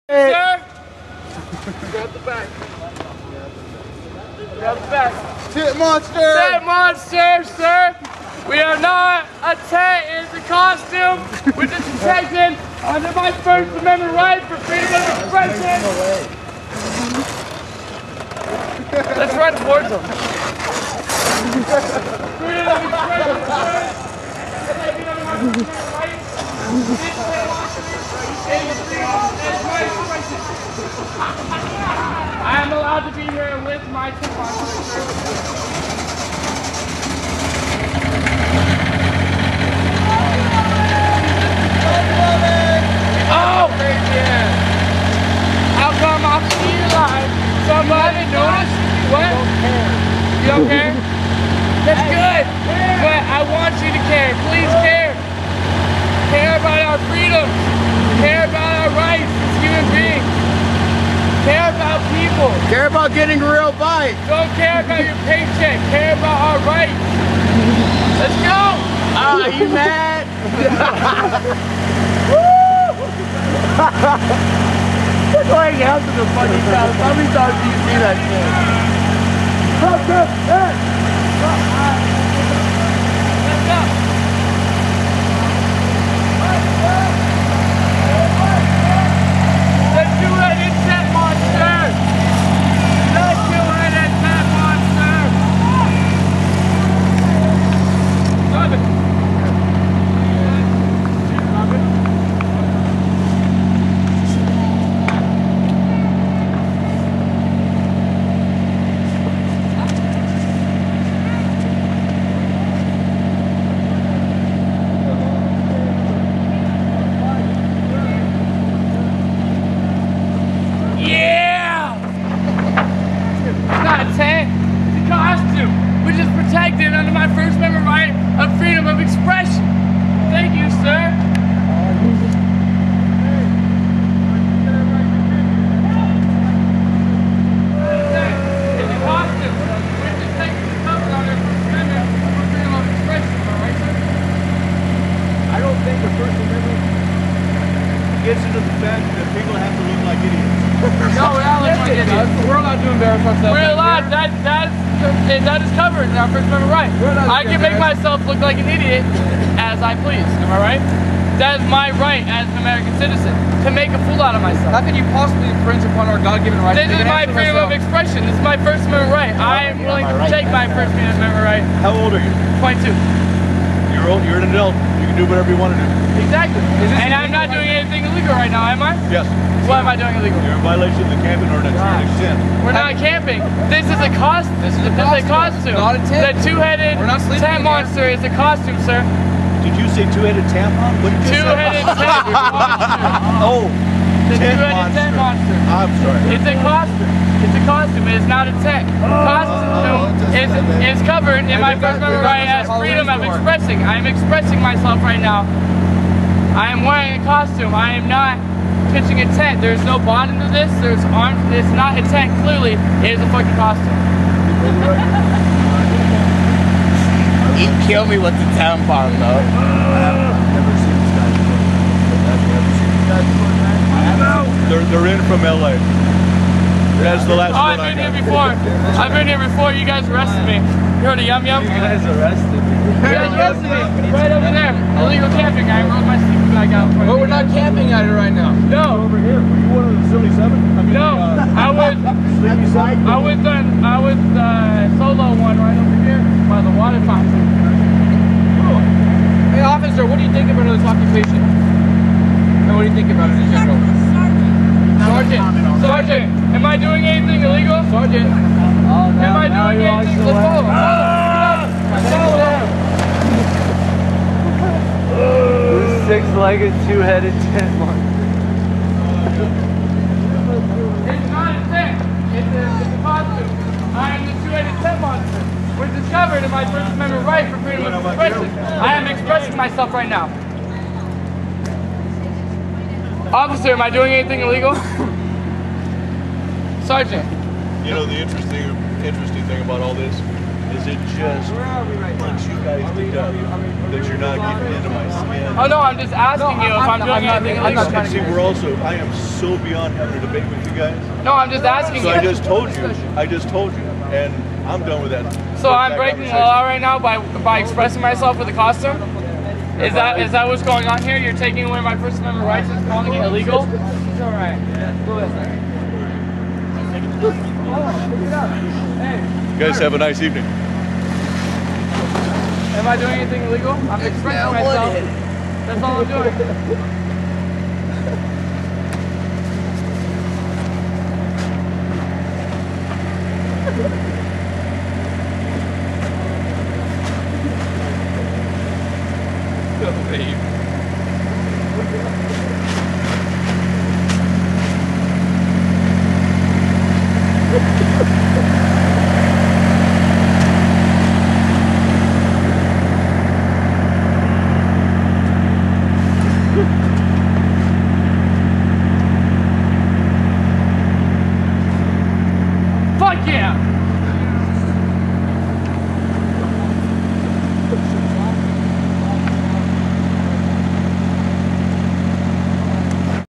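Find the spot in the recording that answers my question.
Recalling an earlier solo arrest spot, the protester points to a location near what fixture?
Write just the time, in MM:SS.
04:06.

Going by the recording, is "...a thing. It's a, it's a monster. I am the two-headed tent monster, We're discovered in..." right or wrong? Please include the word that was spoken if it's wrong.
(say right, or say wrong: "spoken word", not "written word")
right.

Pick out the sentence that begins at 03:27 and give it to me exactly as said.
I am not pitching a tent.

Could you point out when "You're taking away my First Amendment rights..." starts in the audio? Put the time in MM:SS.
05:11.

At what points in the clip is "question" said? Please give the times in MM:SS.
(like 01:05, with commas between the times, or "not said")
not said.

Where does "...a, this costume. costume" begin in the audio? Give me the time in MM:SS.
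03:04.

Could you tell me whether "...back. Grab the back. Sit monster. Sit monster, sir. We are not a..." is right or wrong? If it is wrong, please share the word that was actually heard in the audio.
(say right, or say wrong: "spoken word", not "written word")
right.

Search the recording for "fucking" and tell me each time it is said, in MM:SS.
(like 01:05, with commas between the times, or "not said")
03:33.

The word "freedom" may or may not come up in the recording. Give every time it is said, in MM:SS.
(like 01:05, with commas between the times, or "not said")
00:14, 00:22, 02:47, 03:22, 04:37.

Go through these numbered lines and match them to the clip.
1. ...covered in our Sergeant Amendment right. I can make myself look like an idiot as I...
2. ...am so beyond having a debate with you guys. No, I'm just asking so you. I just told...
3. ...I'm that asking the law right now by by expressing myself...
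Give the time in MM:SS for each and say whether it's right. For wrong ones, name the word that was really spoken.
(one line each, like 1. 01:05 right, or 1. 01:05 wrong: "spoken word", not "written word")
1. 02:35 wrong: "First", not "Sergeant"
2. 04:58 right
3. 05:05 wrong: "breaking", not "asking".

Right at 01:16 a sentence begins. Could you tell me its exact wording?
How many times do you see that shit?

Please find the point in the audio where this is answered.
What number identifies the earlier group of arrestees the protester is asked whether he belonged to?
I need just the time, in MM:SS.
04:00.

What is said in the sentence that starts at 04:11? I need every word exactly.
And what do you think about it in general?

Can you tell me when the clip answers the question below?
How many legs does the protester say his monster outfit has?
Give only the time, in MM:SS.
04:26.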